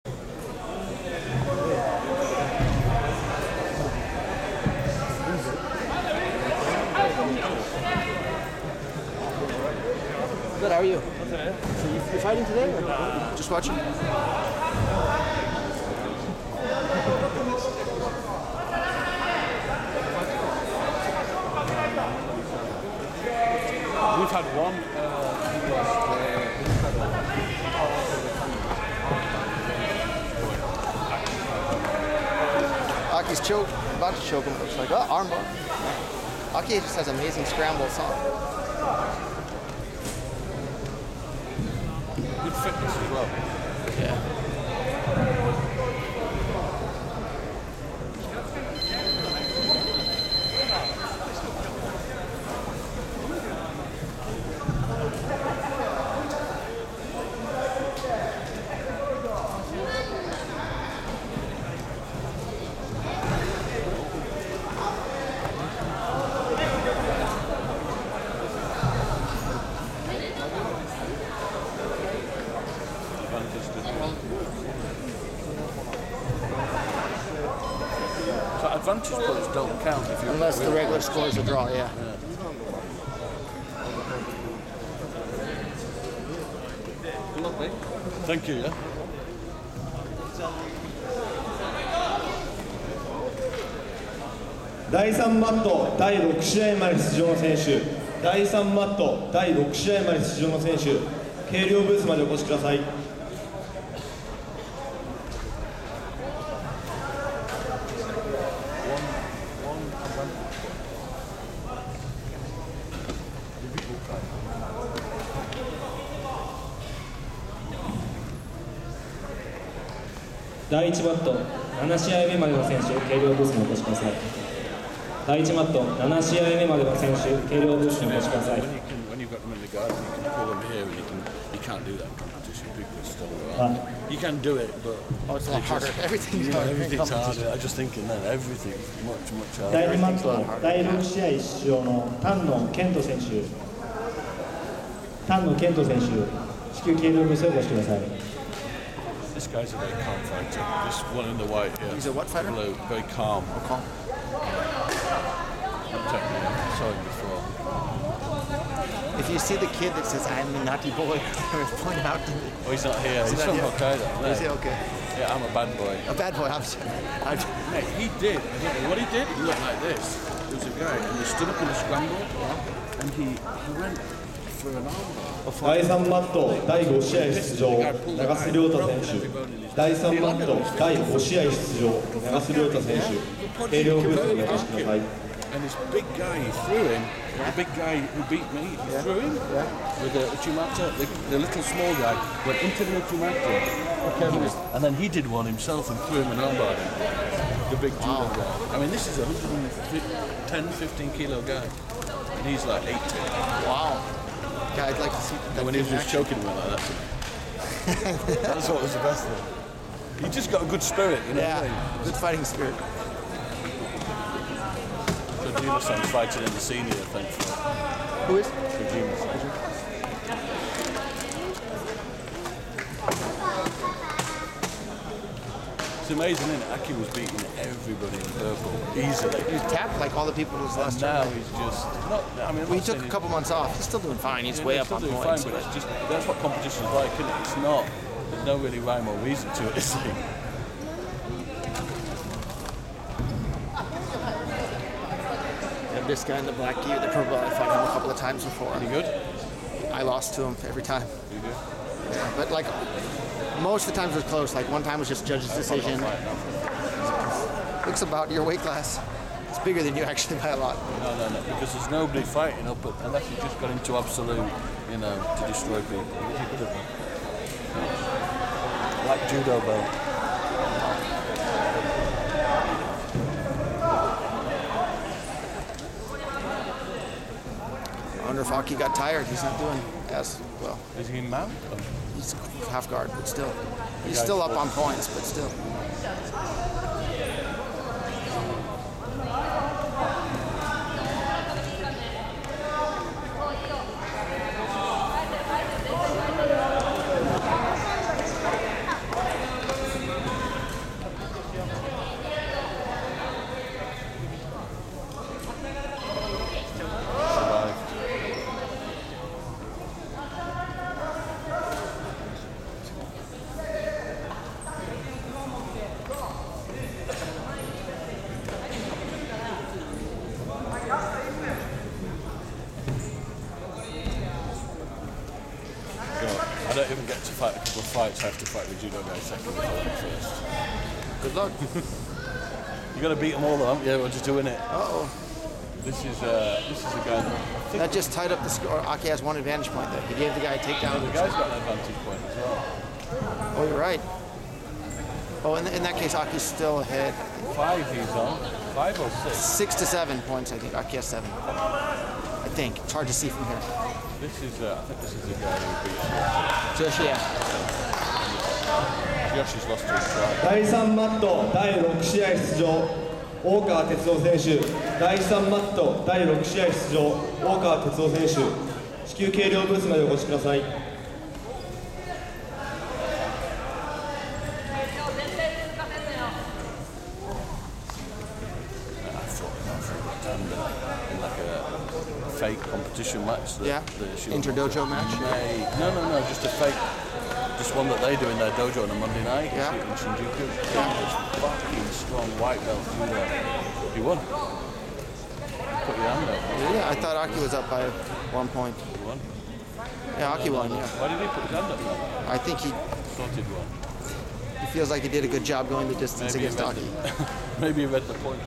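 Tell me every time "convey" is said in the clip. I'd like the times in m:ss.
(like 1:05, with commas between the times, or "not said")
not said.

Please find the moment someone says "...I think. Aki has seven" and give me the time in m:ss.
5:50.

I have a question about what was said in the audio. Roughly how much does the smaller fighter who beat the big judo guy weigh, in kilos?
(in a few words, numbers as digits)
80.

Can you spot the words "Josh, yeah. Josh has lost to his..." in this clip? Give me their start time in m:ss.
5:56.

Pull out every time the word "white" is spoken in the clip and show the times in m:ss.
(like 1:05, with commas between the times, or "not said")
2:31, 6:32.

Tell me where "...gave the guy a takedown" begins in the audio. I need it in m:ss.
5:40.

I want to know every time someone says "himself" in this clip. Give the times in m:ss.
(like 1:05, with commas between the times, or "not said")
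3:15.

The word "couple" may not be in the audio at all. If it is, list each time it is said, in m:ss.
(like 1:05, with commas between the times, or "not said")
3:53, 4:07, 5:27.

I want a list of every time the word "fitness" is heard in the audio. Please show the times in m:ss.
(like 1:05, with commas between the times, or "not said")
0:42.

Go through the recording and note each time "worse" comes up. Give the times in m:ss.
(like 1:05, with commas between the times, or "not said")
not said.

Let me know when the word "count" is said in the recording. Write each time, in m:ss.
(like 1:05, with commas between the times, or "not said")
1:19.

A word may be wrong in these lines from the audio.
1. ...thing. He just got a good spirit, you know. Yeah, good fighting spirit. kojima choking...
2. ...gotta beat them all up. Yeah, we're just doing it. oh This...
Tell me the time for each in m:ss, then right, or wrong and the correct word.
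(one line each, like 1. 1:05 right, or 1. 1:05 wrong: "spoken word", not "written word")
1. 3:29 wrong: "fighting", not "choking"
2. 5:33 right.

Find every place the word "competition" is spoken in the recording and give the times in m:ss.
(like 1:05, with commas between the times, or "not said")
2:12, 3:56, 6:22.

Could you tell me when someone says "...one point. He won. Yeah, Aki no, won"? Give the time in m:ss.
6:38.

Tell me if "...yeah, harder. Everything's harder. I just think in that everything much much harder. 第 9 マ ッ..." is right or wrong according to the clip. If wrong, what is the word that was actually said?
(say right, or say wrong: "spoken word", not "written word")
wrong: "2", not "9".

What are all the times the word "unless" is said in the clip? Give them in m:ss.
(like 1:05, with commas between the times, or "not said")
1:20, 4:23.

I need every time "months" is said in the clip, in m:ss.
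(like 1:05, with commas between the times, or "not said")
3:53.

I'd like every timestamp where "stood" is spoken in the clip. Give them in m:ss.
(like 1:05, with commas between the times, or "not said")
2:51.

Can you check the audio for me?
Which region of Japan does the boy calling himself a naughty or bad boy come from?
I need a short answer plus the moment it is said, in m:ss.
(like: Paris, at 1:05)
Hokkaido, at 2:43.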